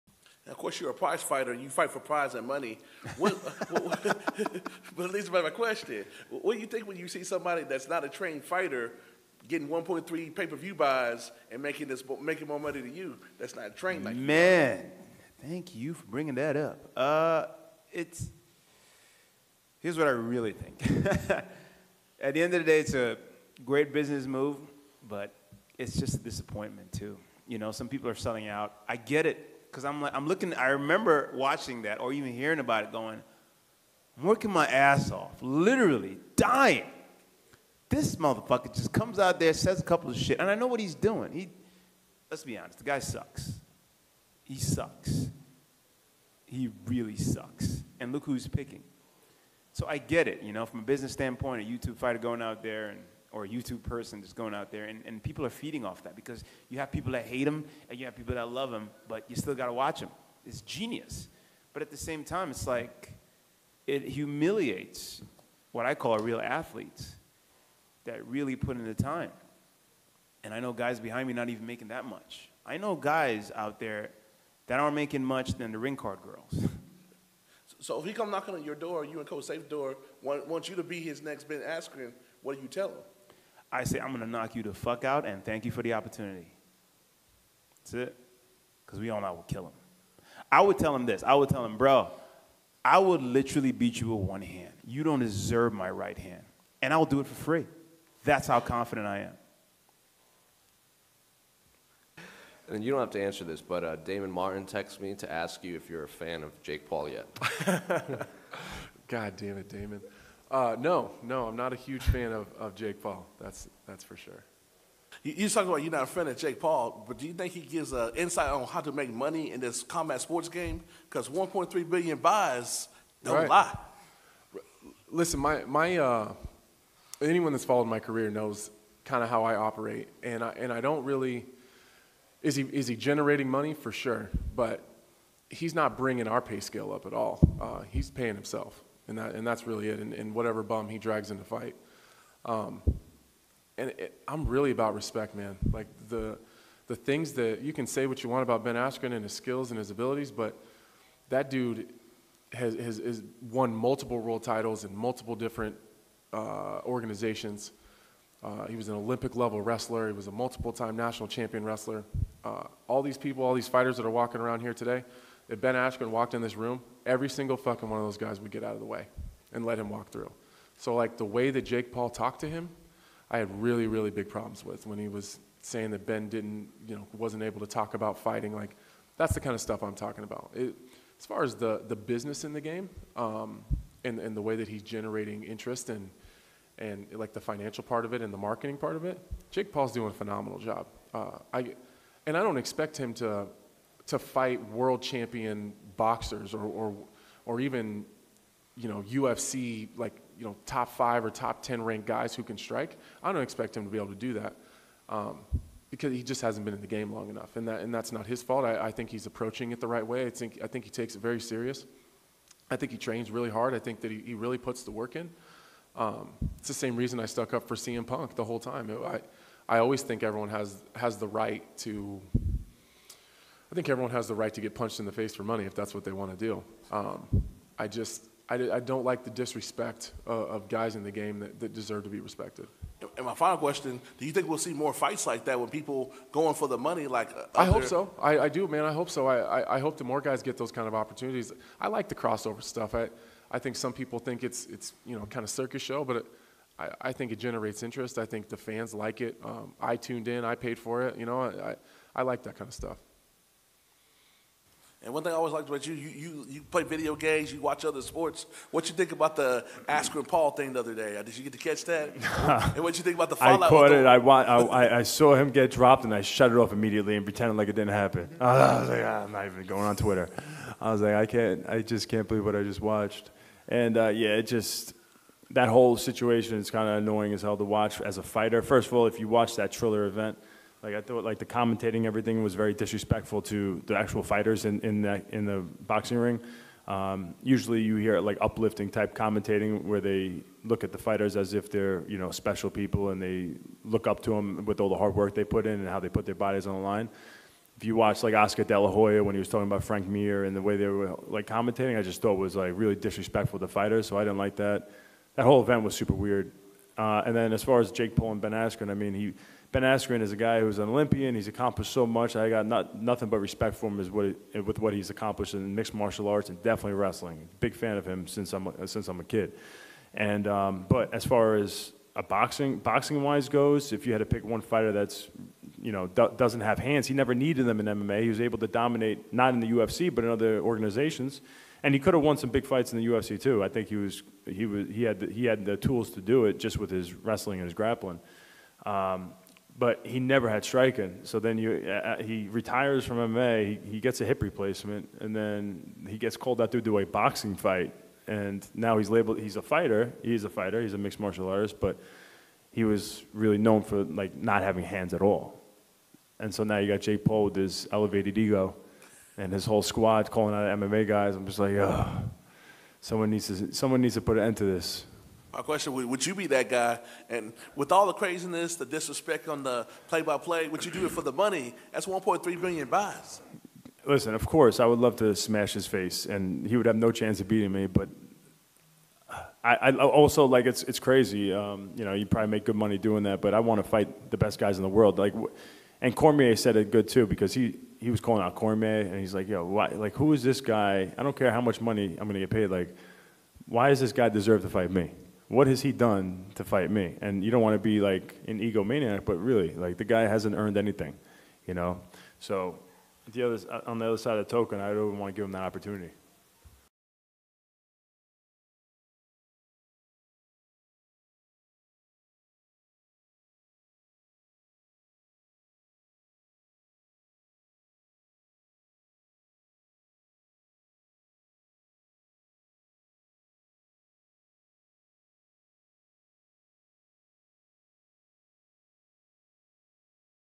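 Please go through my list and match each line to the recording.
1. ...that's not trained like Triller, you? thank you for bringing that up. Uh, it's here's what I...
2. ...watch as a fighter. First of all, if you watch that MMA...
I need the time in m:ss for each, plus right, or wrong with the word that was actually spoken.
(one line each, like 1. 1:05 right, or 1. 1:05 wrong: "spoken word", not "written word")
1. 0:13 wrong: "Man", not "Triller"
2. 4:37 wrong: "Triller", not "MMA".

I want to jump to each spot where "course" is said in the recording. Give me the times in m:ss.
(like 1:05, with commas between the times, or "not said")
0:00, 6:14.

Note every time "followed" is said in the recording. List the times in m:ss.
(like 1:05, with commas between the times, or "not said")
2:07.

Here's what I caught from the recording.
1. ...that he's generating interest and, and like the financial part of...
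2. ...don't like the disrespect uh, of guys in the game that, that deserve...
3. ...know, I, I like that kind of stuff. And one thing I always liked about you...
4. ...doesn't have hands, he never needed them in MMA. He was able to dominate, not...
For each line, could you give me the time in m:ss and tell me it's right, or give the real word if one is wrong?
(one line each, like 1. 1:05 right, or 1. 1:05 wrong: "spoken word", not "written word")
1. 3:04 right
2. 3:48 right
3. 4:11 right
4. 5:26 right.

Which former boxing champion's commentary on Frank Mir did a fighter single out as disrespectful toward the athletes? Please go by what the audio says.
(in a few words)
Oscar De La Hoya.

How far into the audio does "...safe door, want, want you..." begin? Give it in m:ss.
1:19.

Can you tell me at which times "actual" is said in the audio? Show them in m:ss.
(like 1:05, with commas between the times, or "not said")
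4:43.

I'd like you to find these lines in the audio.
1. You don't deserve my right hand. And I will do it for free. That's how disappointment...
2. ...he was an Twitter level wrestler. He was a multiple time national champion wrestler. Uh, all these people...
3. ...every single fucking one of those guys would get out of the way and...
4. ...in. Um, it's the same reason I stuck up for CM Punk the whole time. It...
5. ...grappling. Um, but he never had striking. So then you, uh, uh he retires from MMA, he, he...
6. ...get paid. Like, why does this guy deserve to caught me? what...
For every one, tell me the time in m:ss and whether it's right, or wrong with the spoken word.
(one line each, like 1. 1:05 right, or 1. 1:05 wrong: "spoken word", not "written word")
1. 1:34 wrong: "confident", not "disappointment"
2. 2:38 wrong: "Olympic", not "Twitter"
3. 2:47 right
4. 3:35 right
5. 5:37 right
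6. 6:32 wrong: "fight", not "caught".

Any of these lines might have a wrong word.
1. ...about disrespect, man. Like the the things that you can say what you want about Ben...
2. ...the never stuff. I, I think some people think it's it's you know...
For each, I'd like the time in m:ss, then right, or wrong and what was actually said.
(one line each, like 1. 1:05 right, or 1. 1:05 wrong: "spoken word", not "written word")
1. 2:24 wrong: "respect", not "disrespect"
2. 4:02 wrong: "crossover", not "never".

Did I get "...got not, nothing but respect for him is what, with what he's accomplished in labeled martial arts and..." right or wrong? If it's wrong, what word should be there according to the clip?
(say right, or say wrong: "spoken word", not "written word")
wrong: "mixed", not "labeled".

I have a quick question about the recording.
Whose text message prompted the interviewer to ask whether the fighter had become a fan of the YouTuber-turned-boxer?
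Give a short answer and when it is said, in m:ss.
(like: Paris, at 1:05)
Damon Martin, at 1:43.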